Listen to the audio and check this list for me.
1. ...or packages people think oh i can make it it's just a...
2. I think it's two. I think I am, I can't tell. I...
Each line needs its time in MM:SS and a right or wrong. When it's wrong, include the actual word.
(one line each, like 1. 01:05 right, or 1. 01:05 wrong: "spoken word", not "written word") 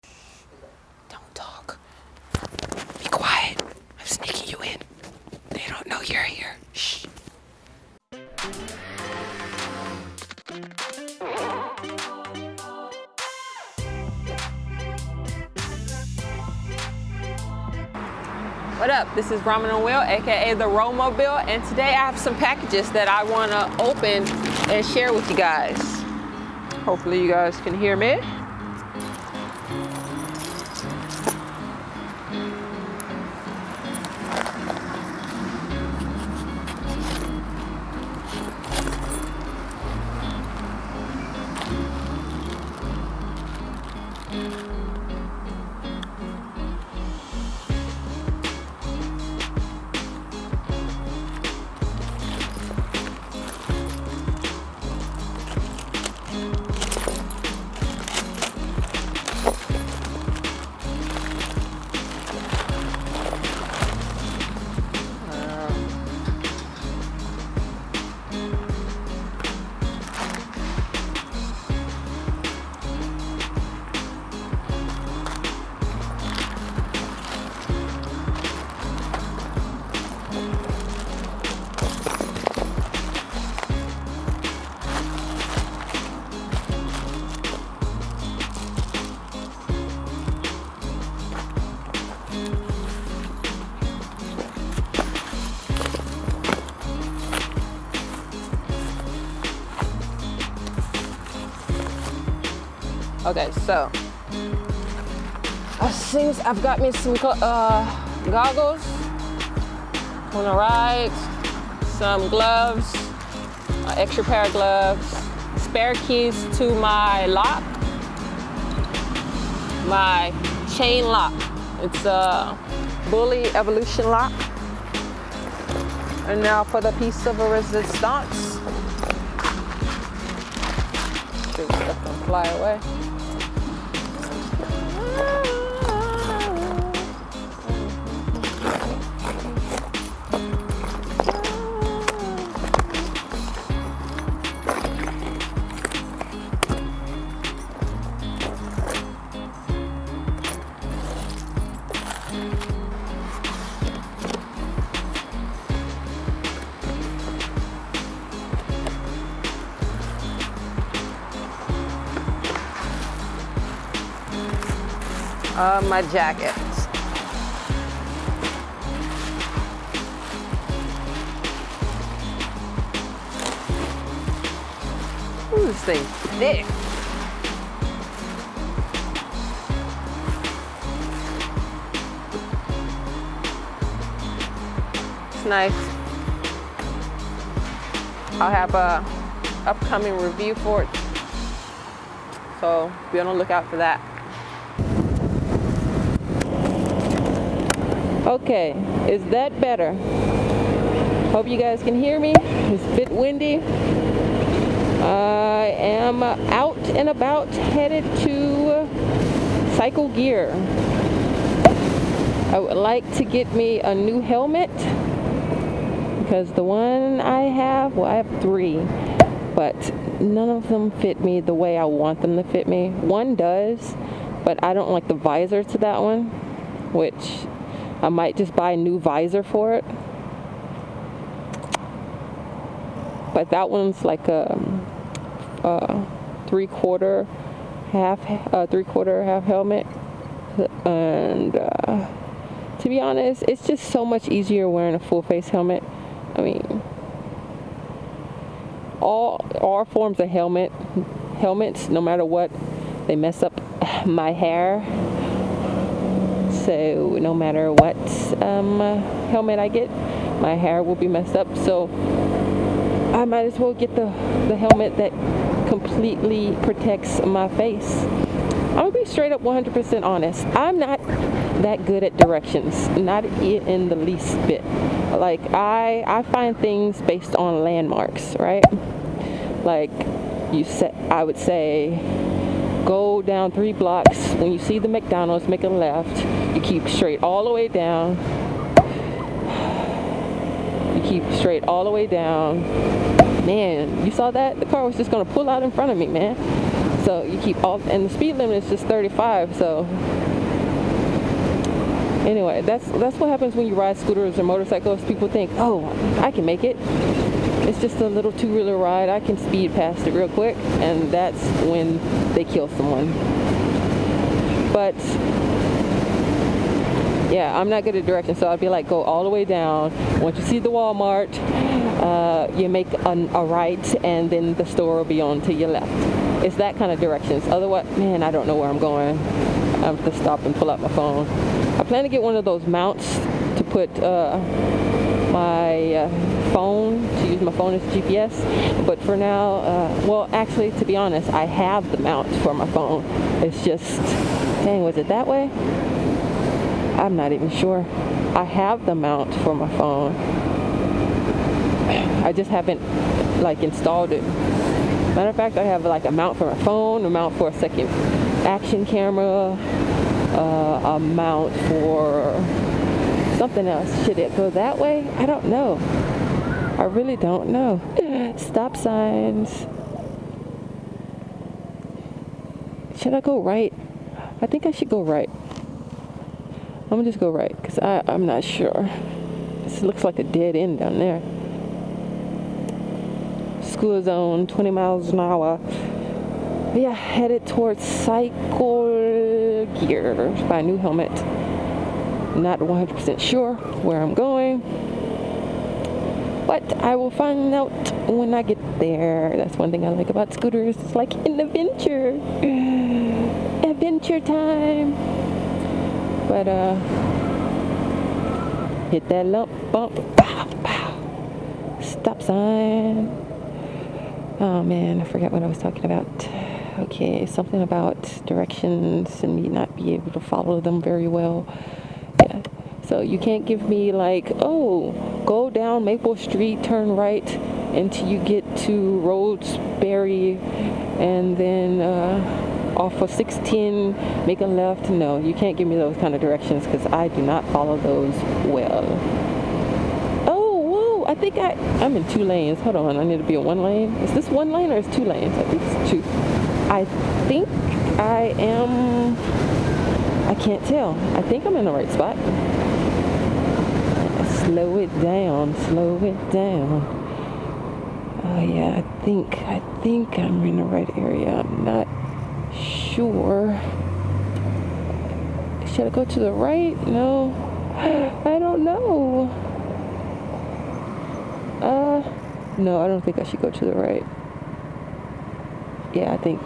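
1. 05:04 wrong: "motorcycles", not "packages"
2. 07:25 right.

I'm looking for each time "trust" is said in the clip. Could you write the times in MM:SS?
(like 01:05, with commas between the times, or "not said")
not said.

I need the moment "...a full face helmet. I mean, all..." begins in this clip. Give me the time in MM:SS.
04:04.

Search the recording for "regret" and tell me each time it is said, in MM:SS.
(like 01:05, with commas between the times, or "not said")
not said.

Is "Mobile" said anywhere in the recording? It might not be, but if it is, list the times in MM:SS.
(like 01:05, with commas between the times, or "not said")
00:20.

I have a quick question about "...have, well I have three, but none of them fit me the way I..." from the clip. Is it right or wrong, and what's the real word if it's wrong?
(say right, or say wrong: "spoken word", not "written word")
right.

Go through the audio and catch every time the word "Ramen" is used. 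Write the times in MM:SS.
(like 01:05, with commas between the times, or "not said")
00:19.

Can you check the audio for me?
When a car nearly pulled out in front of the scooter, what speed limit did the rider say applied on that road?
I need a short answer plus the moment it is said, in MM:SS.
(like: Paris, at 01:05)
35, at 04:58.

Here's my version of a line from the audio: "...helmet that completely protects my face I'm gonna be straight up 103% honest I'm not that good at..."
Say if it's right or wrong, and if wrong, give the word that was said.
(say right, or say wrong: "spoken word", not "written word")
wrong: "100", not "103".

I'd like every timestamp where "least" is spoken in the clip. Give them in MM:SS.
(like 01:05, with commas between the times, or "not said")
04:33.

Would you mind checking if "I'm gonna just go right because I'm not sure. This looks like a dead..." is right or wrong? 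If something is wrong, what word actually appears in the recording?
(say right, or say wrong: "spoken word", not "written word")
right.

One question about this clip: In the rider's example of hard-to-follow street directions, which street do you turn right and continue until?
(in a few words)
Roseberry.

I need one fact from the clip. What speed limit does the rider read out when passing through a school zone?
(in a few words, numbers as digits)
20 miles an hour.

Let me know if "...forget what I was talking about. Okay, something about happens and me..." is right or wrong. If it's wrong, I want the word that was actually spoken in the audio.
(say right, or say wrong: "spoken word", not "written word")
wrong: "directions", not "happens".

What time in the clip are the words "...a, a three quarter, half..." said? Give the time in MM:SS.
03:54.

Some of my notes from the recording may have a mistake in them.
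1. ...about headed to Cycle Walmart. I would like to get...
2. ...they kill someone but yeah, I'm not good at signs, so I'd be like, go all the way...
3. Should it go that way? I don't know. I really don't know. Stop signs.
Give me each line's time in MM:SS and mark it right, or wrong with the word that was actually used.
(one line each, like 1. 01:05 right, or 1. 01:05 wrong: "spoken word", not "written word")
1. 03:27 wrong: "Gear", not "Walmart"
2. 05:12 wrong: "directions", not "signs"
3. 06:04 right.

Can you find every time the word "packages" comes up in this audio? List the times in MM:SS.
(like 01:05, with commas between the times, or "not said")
00:22.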